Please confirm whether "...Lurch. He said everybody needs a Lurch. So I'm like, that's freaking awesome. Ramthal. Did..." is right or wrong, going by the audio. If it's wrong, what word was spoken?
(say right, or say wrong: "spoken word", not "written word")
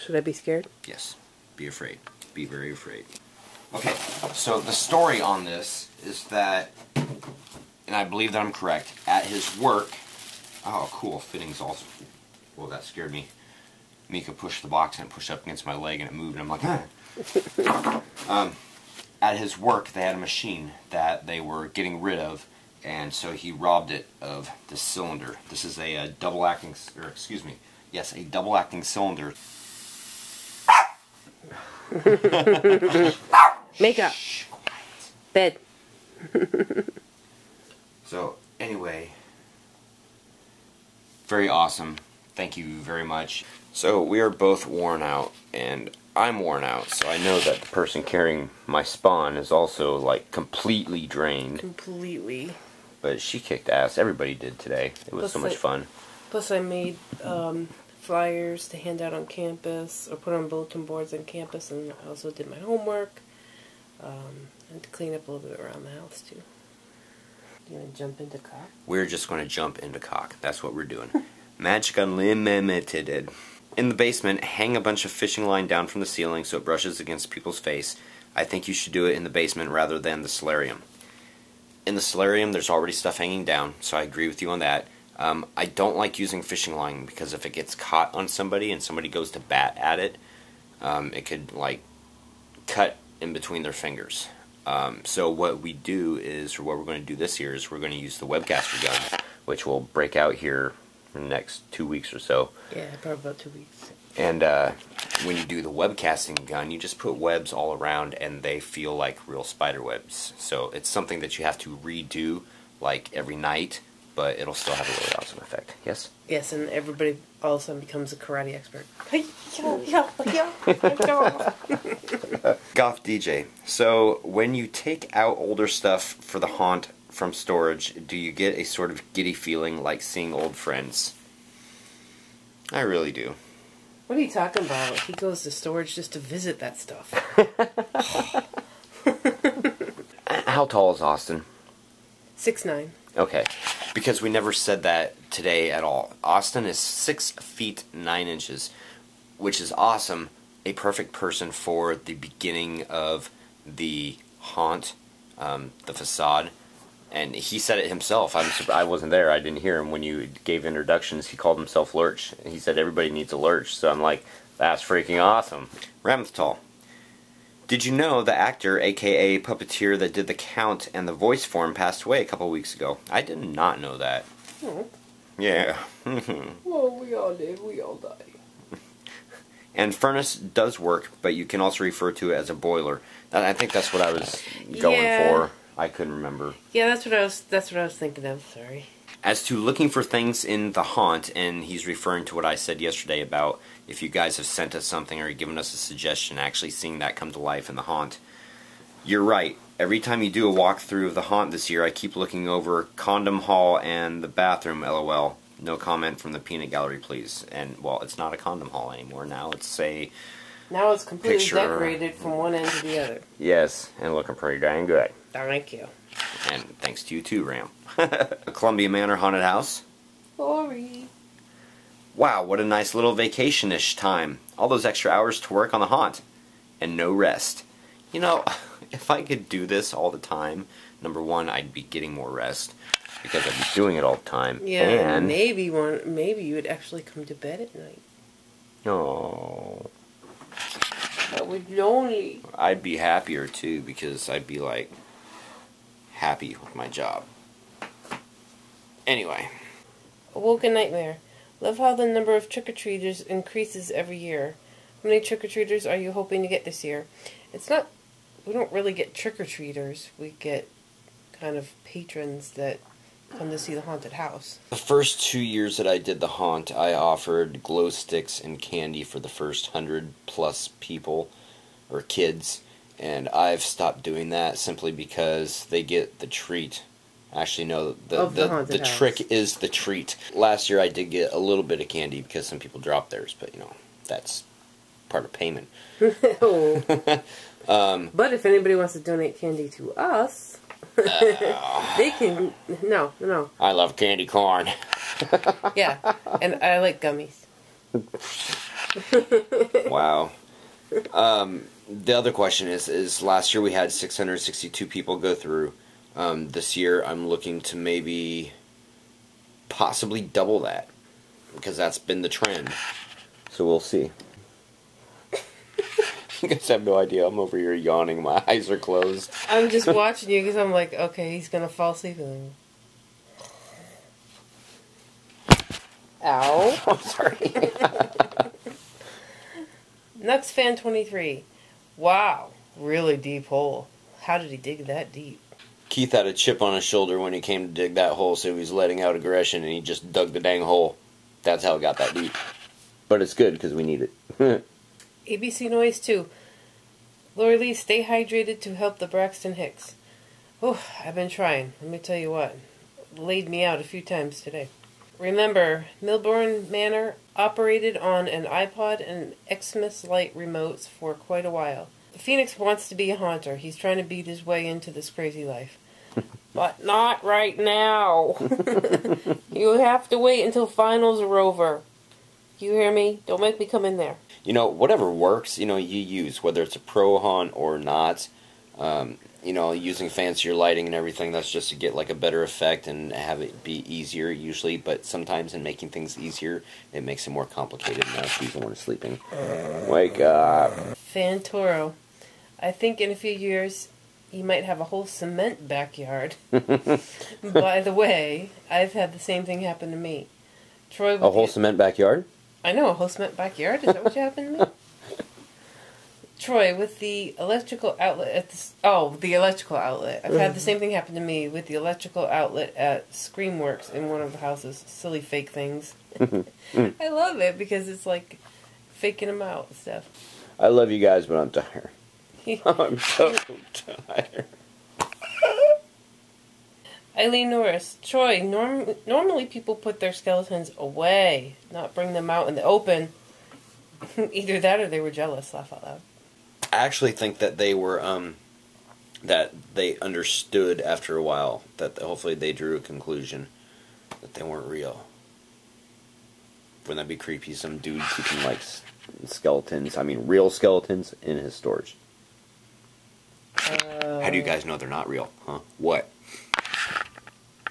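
right.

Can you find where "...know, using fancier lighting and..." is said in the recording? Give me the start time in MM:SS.
06:19.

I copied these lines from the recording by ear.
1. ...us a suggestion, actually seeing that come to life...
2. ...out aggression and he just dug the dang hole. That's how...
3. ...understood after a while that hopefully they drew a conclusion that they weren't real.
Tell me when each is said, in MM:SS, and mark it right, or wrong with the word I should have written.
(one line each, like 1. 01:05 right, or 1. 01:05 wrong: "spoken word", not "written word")
1. 03:15 right
2. 05:39 right
3. 07:19 right.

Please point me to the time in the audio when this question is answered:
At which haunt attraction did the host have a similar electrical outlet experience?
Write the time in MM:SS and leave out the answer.
06:53.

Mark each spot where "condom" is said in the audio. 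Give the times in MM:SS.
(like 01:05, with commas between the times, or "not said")
03:22, 03:28.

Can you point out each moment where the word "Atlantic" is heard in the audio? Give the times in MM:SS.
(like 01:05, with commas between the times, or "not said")
not said.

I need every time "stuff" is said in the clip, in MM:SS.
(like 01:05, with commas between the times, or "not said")
01:22, 02:05, 02:16, 06:59.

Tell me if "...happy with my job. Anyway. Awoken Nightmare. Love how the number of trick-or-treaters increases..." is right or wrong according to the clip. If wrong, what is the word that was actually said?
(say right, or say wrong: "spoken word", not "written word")
right.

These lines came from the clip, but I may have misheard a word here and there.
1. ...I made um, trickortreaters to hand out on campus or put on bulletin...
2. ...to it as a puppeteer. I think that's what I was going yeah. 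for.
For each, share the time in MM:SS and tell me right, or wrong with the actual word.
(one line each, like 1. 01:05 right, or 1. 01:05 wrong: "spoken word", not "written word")
1. 00:56 wrong: "flyers", not "trickortreaters"
2. 03:02 wrong: "boiler", not "puppeteer".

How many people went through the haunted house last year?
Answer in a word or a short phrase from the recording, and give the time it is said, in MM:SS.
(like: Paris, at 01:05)
662, at 05:03.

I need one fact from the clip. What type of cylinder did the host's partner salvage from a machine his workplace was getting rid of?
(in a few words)
double acting cylinder.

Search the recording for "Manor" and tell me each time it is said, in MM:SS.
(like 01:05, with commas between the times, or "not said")
03:38, 05:56.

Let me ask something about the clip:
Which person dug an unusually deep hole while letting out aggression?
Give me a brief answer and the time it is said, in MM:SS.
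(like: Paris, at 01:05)
Keith, at 05:35.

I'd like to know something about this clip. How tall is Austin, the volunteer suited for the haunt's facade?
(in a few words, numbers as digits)
6 feet 9 inches.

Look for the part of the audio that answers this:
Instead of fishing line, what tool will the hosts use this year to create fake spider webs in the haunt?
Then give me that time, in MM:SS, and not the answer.
01:38.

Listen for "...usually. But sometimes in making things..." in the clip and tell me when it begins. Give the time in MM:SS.
06:24.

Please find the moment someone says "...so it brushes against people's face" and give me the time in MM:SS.
01:16.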